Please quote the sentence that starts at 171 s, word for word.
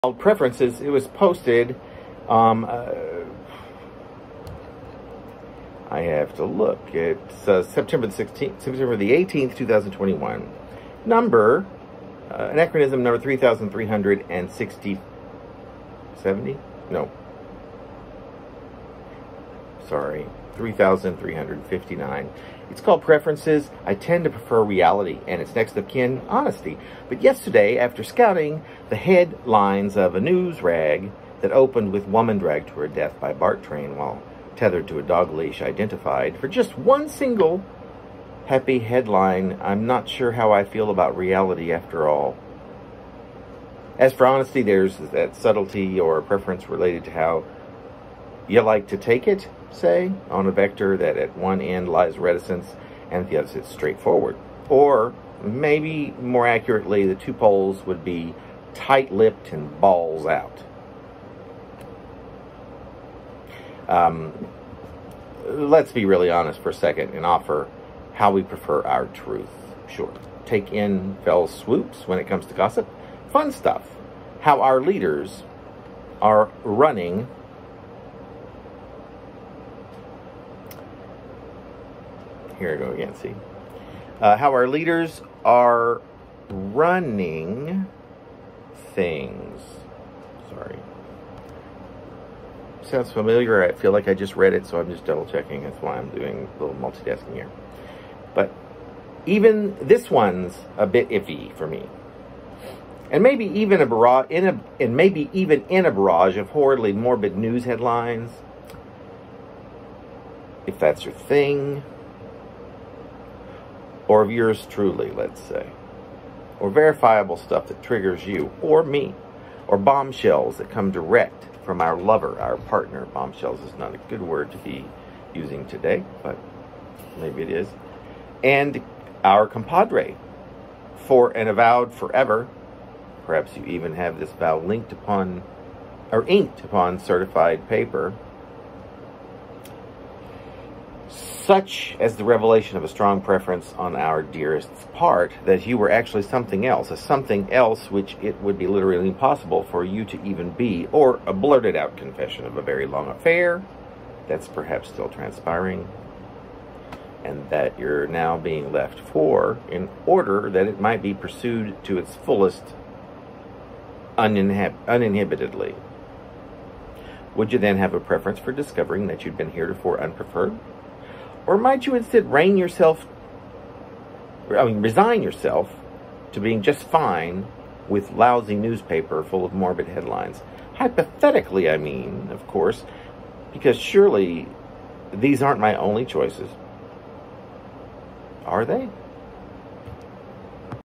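Or might you instead rein yourself, I mean, resign yourself to being just fine with lousy newspaper full of morbid headlines?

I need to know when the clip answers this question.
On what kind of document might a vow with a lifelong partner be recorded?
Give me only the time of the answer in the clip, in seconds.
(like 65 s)
136 s.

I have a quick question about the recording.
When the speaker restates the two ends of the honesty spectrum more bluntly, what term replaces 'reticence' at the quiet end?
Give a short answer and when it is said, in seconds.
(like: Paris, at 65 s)
tight-lipped, at 58 s.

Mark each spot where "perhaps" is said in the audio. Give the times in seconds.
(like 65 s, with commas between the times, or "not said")
133 s, 154 s.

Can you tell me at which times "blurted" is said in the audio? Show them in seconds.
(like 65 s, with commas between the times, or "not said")
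151 s.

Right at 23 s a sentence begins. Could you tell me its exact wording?
I tend to prefer reality, and it's next of kin honesty.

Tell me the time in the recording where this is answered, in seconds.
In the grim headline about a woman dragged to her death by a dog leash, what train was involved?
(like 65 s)
33 s.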